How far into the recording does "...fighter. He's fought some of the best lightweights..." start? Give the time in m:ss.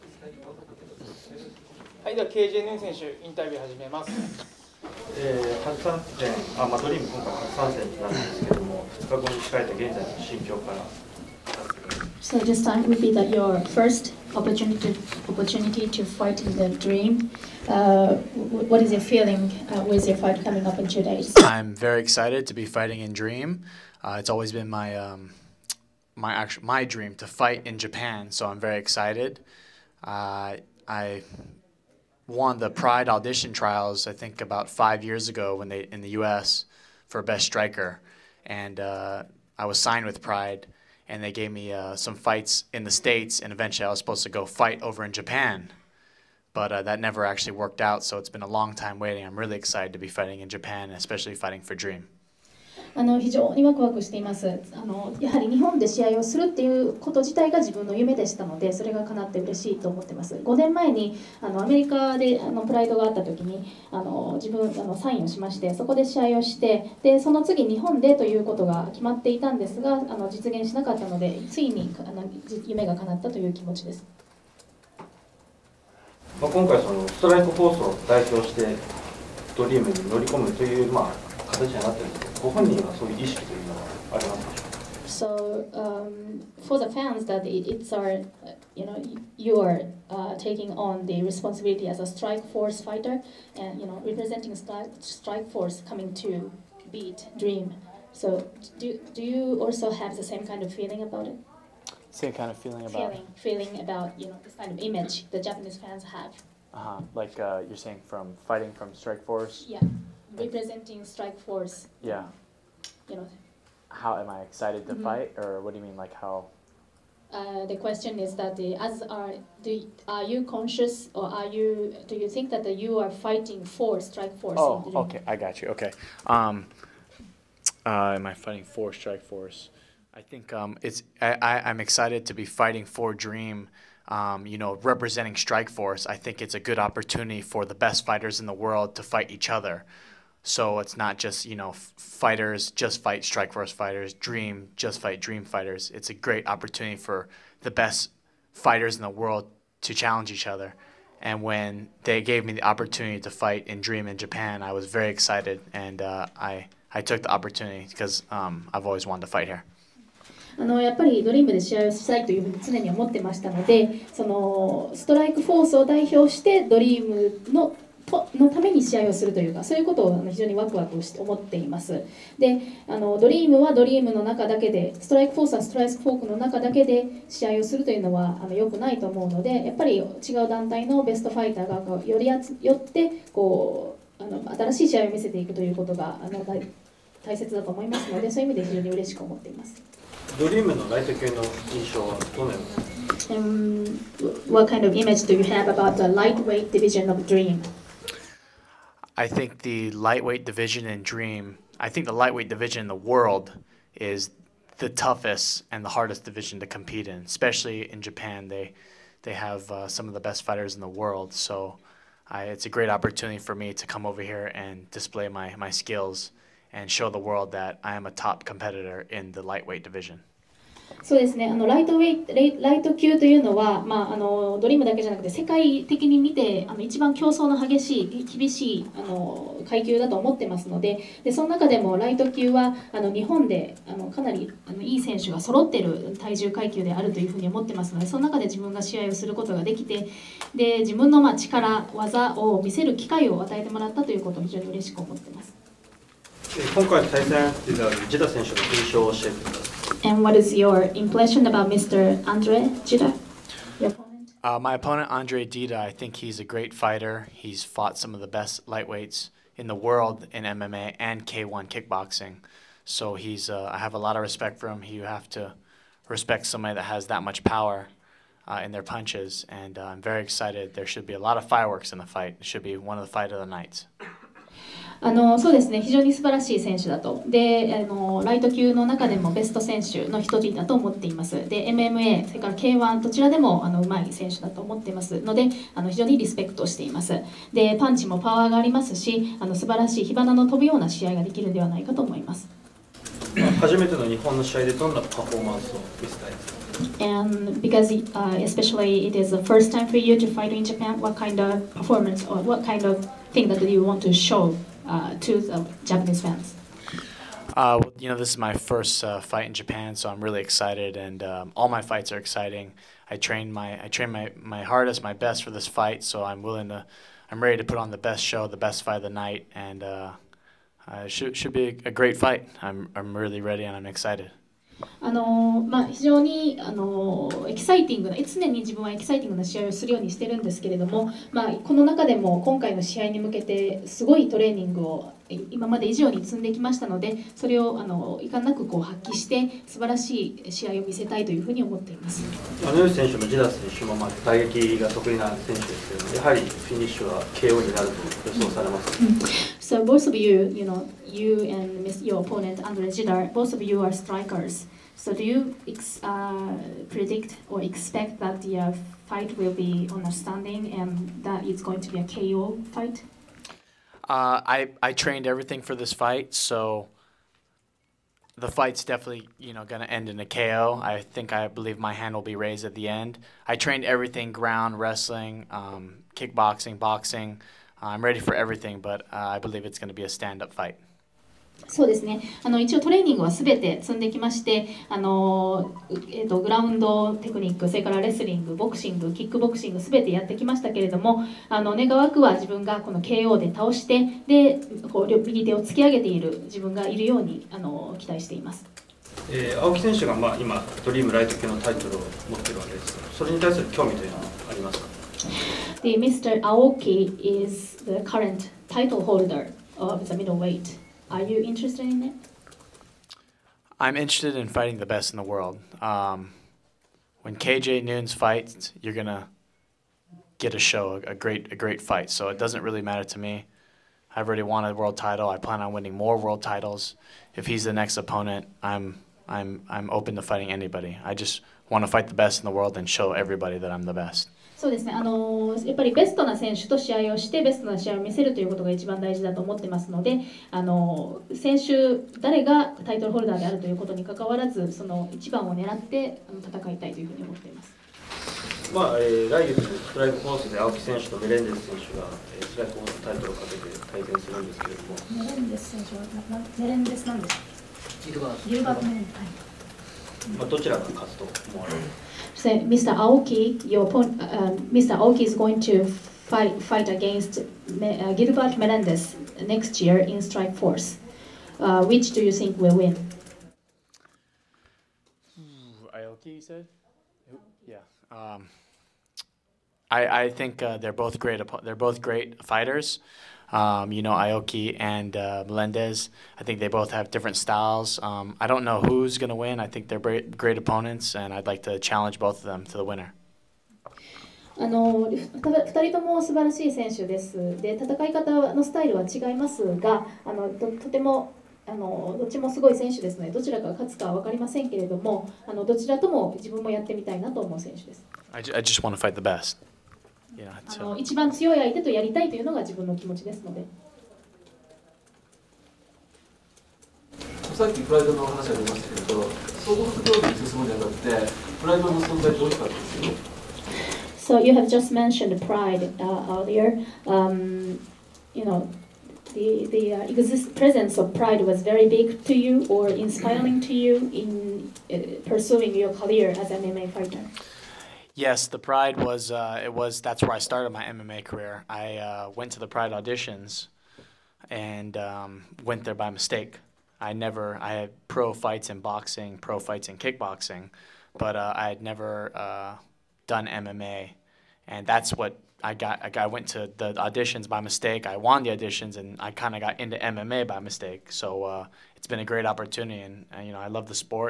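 4:16.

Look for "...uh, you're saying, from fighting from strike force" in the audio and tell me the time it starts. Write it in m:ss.
1:47.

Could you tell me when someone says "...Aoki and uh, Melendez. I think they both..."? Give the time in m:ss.
8:04.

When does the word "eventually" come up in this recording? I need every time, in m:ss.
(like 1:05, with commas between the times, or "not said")
0:43.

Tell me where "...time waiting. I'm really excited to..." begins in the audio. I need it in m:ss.
0:48.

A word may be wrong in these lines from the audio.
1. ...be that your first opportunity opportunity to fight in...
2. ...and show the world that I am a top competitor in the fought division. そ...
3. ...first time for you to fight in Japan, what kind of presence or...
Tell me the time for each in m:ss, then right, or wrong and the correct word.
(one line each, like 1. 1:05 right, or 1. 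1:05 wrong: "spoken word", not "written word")
1. 0:13 right
2. 3:36 wrong: "lightweight", not "fought"
3. 4:59 wrong: "performance", not "presence".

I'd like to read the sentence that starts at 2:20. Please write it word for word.
So it's not just, you know, fighters just fight strike force fighters, dream just fight dream fighters.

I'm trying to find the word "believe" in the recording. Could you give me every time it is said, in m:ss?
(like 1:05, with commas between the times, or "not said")
6:11, 6:19.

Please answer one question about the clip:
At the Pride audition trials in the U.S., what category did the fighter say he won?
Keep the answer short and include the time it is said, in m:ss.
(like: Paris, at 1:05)
Best striker, at 0:37.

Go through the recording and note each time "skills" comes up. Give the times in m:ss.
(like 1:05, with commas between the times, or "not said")
3:35.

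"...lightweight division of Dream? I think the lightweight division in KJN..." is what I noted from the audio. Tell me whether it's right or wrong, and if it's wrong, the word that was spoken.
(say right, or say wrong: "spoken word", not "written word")
wrong: "Dream", not "KJN".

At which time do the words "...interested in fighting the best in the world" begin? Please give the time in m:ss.
6:53.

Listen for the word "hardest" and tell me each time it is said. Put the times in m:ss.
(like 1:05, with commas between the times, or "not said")
3:25, 5:14.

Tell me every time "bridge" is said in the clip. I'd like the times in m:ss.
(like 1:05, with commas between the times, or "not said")
not said.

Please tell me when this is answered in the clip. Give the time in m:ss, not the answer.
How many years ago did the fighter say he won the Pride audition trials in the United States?
0:34.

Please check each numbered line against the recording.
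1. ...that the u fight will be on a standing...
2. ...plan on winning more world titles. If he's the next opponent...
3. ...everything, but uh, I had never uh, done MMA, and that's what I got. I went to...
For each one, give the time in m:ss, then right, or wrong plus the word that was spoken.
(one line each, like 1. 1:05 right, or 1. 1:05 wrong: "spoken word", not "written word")
1. 5:58 right
2. 7:05 right
3. 9:09 wrong: "kickboxing", not "everything".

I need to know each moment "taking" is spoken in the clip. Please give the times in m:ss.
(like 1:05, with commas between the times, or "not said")
1:30.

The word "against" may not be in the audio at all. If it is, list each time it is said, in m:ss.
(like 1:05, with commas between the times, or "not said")
7:46.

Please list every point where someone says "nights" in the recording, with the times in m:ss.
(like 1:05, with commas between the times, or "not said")
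4:33, 5:19.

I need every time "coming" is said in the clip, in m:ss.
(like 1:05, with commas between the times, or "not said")
0:20, 1:35.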